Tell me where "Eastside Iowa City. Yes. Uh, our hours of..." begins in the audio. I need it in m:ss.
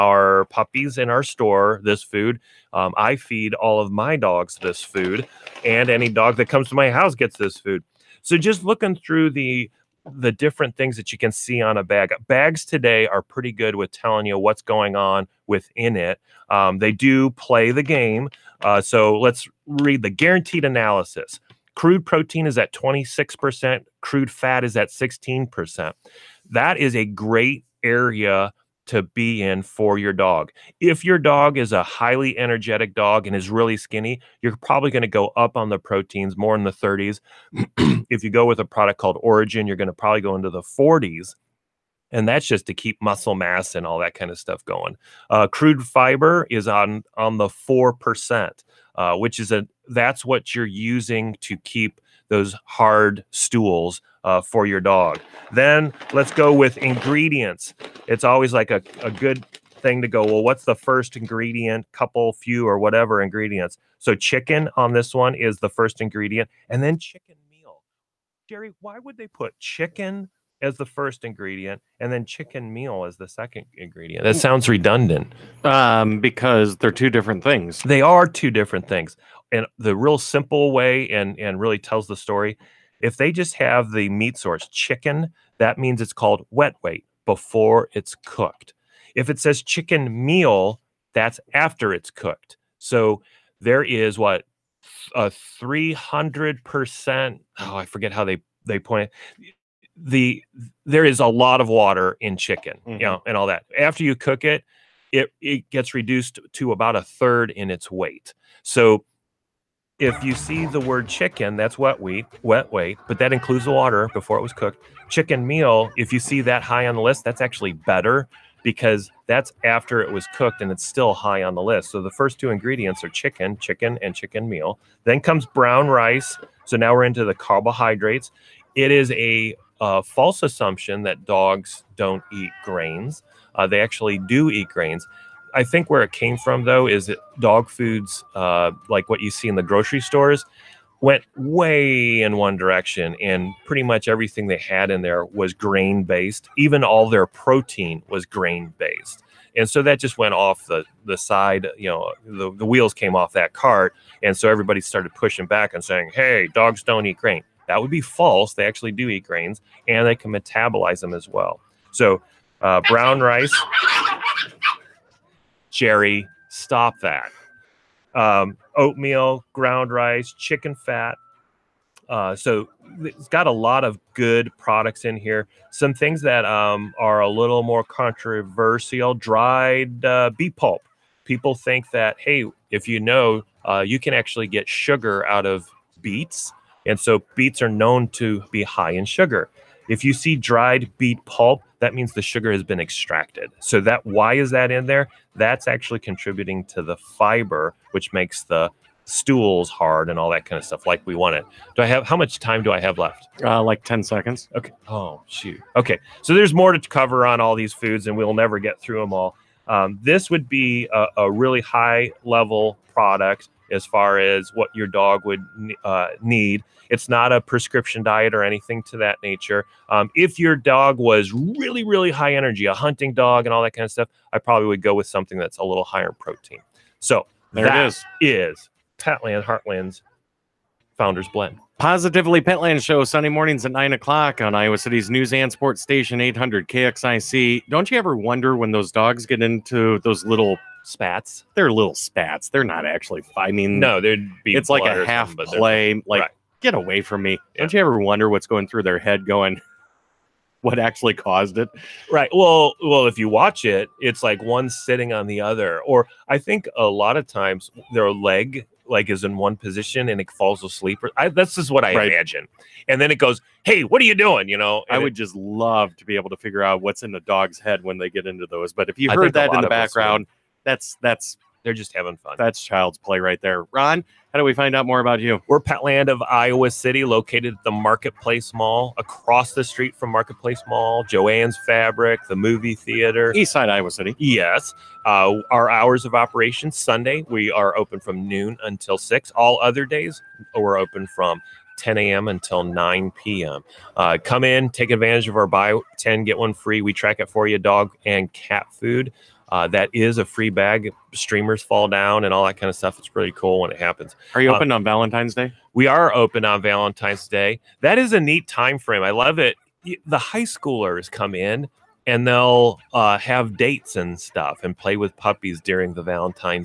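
4:43.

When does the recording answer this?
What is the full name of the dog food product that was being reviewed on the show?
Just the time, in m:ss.
3:49.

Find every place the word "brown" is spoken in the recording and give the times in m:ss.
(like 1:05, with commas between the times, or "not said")
2:05, 2:42.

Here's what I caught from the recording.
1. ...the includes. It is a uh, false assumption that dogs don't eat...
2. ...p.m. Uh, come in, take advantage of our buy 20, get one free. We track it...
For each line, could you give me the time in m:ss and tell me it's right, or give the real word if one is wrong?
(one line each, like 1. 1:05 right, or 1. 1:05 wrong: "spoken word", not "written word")
1. 2:07 wrong: "carbohydrates", not "includes"
2. 4:53 wrong: "10", not "20".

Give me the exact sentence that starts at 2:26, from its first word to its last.
Even all their protein was grain based, and so that just went off the the side.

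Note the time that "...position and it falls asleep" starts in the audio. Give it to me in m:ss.
4:19.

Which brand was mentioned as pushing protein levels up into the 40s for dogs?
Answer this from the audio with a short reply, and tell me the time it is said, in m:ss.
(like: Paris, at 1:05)
Origin, at 0:39.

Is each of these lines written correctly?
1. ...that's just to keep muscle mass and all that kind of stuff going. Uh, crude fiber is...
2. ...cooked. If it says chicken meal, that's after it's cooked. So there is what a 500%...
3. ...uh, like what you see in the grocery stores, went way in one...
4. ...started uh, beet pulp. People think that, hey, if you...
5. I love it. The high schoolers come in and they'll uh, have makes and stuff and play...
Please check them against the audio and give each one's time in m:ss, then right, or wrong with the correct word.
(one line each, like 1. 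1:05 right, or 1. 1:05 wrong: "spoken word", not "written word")
1. 0:42 right
2. 1:28 wrong: "300", not "500"
3. 2:18 right
4. 2:59 wrong: "dried", not "started"
5. 5:09 wrong: "dates", not "makes".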